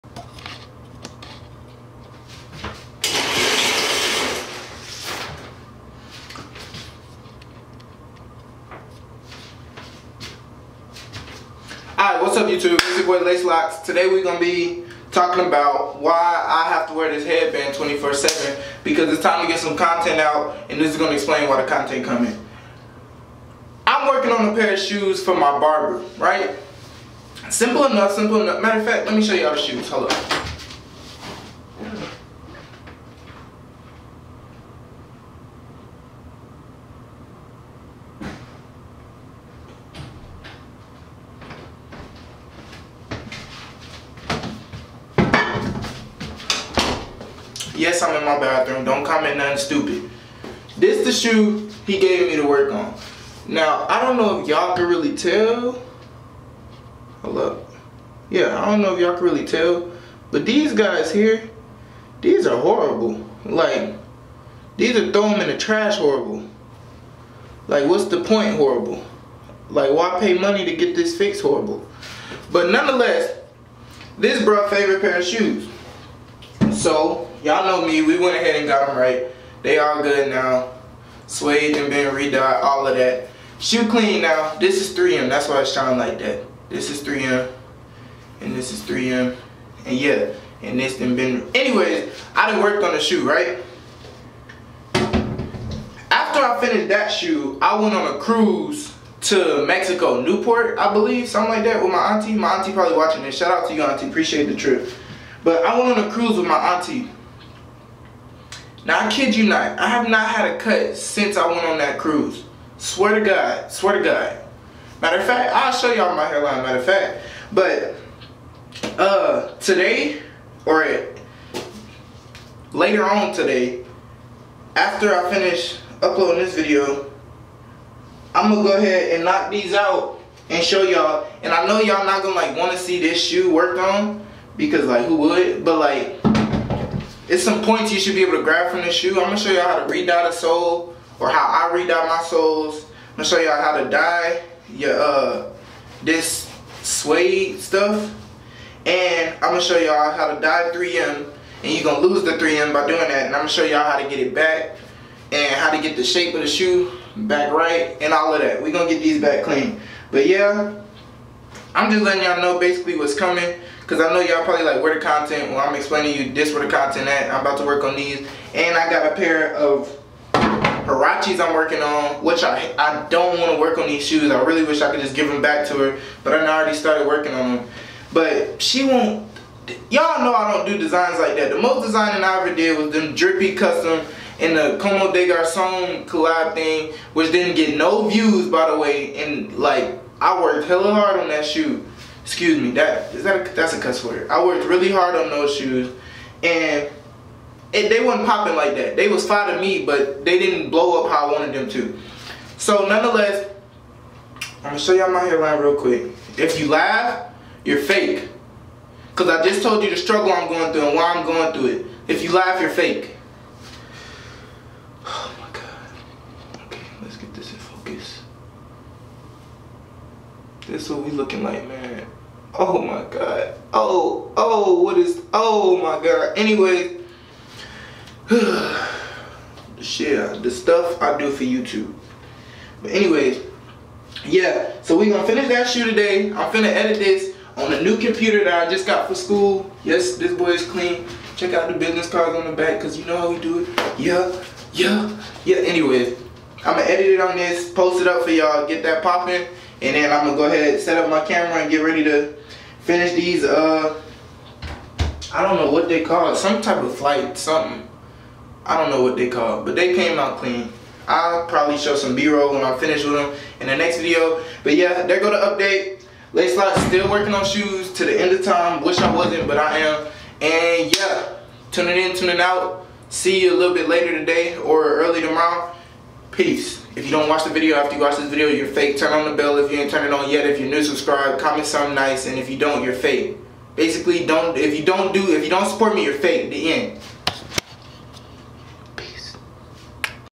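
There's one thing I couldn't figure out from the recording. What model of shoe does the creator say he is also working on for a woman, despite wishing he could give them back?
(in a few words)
Huaraches.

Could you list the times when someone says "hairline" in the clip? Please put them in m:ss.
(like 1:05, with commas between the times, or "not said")
1:56, 3:25.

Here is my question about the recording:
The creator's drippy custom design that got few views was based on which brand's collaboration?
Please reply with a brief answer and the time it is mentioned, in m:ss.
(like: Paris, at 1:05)
Comme des Garçons, at 3:04.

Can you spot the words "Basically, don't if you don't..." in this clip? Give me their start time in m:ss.
4:43.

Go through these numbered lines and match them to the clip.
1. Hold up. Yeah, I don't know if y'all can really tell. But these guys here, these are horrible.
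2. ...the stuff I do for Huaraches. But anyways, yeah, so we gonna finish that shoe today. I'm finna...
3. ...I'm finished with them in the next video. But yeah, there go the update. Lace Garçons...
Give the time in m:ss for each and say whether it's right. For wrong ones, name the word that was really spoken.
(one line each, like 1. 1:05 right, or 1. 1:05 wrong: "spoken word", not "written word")
1. 0:57 right
2. 3:50 wrong: "YouTube", not "Huaraches"
3. 4:22 wrong: "Slot", not "Garçons".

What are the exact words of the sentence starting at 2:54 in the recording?
I really wish I could just give them back to her, but I already started working on them.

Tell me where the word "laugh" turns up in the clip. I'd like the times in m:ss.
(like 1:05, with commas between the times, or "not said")
3:26, 3:32.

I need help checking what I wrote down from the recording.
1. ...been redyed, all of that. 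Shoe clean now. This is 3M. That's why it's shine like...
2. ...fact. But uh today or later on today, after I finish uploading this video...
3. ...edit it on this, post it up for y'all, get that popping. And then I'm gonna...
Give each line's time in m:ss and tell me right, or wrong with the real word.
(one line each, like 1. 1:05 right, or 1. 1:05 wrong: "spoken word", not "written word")
1. 1:21 right
2. 1:56 right
3. 4:06 right.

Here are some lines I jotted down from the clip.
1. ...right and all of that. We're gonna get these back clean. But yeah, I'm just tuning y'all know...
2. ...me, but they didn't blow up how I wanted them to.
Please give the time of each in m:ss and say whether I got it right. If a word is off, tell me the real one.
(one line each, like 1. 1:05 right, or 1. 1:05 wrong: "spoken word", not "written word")
1. 2:37 wrong: "letting", not "tuning"
2. 3:19 right.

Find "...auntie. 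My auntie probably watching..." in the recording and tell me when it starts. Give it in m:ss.
1:42.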